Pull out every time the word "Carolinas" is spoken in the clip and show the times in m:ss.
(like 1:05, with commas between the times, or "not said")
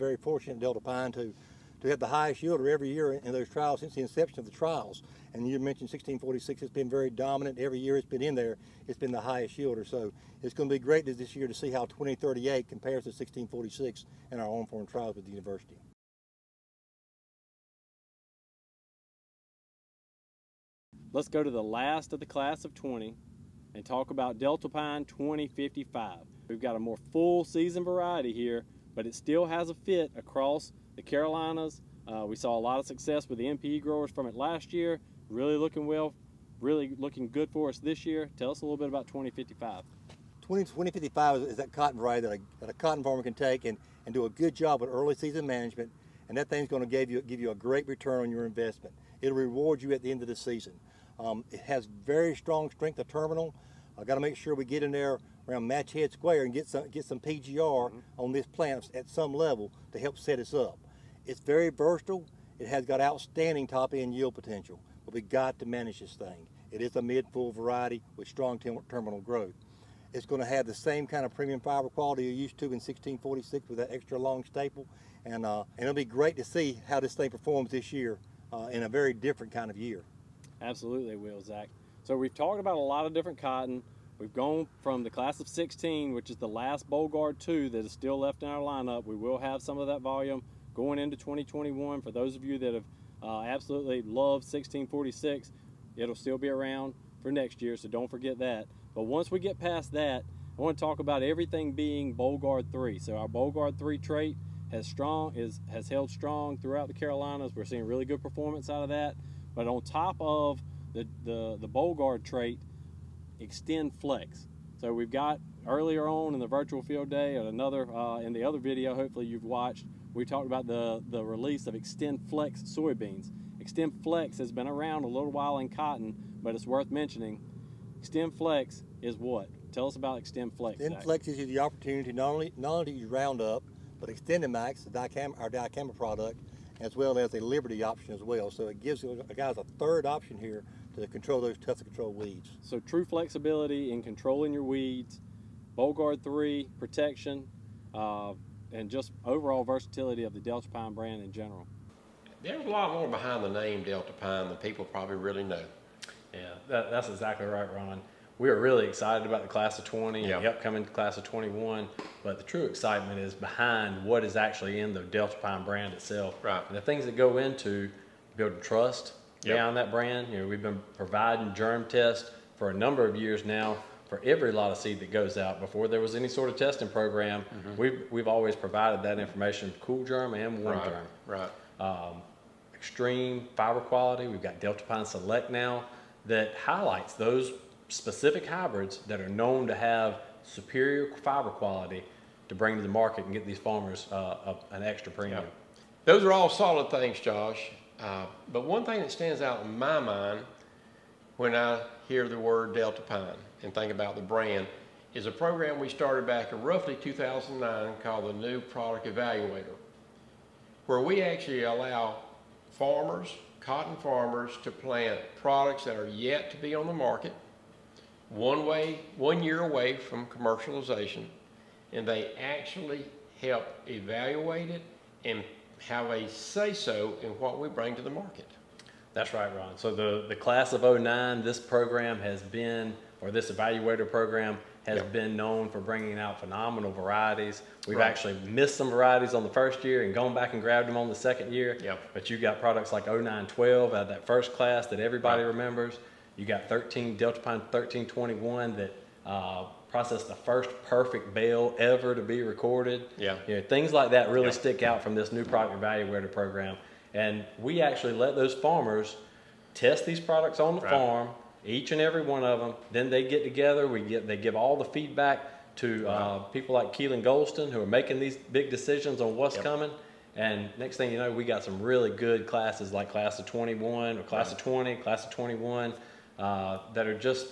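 0:31, 1:46.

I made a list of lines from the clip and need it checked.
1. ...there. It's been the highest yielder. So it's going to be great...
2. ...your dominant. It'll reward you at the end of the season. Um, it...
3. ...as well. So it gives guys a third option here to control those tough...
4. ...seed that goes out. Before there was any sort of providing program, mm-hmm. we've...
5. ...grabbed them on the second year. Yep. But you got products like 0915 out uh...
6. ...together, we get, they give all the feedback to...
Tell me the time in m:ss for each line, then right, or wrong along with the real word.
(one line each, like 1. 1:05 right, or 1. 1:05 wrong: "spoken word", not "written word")
1. 0:08 right
2. 0:48 wrong: "investment", not "dominant"
3. 2:18 right
4. 2:54 wrong: "testing", not "providing"
5. 4:00 wrong: "0912", not "0915"
6. 4:23 right.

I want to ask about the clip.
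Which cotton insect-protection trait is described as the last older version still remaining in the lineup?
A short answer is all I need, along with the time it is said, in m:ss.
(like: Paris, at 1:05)
Bollgard 2, at 1:26.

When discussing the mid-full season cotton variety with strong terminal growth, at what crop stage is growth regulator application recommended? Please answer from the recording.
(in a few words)
Match Head Square.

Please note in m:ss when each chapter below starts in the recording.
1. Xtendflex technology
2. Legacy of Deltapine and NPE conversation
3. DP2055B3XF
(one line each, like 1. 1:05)
1. 1:54
2. 2:30
3. 0:18.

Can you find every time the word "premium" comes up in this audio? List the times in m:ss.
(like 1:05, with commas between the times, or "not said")
1:11, 3:15.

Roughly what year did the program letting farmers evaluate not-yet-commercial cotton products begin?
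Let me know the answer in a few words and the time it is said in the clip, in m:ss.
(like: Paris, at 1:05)
2009, at 3:26.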